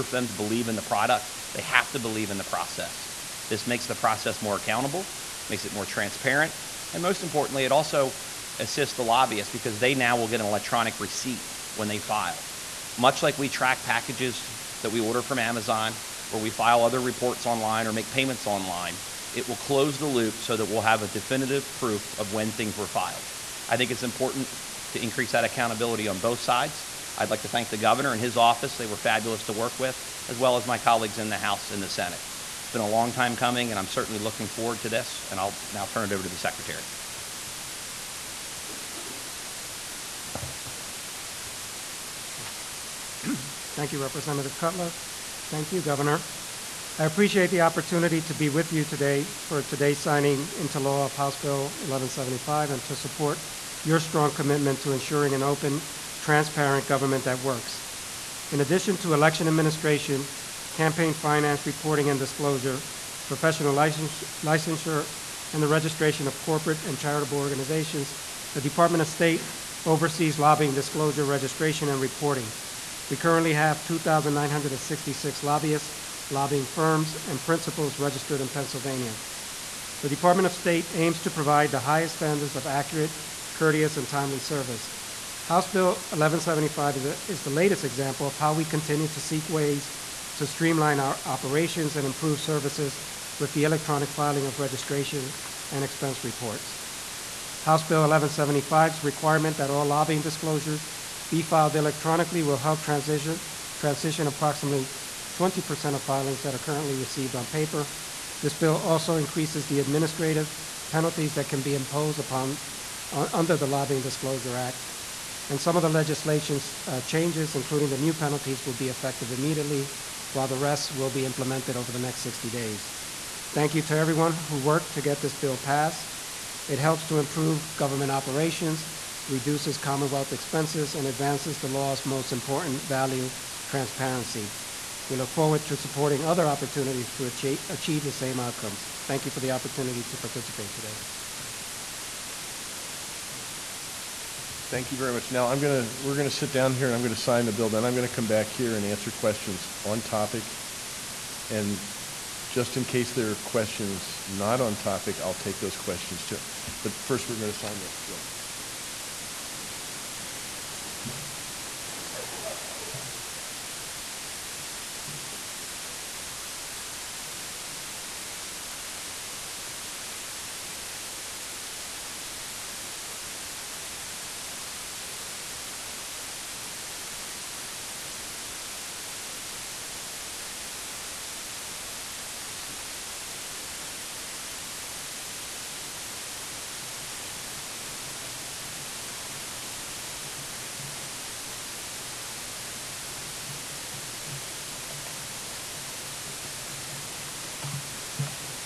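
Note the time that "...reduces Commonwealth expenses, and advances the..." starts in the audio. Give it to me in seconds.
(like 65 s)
129 s.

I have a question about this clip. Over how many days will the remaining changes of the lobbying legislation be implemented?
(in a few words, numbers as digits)
60 days.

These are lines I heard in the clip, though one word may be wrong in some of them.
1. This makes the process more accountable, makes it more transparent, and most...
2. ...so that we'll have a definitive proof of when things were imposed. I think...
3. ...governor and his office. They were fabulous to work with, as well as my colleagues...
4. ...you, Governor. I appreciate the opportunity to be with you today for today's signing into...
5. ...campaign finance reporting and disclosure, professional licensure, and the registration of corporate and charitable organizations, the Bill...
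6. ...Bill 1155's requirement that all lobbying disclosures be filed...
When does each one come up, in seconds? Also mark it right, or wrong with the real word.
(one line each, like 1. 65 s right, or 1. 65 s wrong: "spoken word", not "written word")
1. 3 s right
2. 20 s wrong: "filed", not "imposed"
3. 27 s right
4. 45 s right
5. 60 s wrong: "Department", not "Bill"
6. 97 s wrong: "1175", not "1155".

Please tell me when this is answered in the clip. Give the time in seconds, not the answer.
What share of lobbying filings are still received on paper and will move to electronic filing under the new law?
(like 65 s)
105 s.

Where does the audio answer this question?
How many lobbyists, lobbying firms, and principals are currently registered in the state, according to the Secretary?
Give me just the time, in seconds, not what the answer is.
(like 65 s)
73 s.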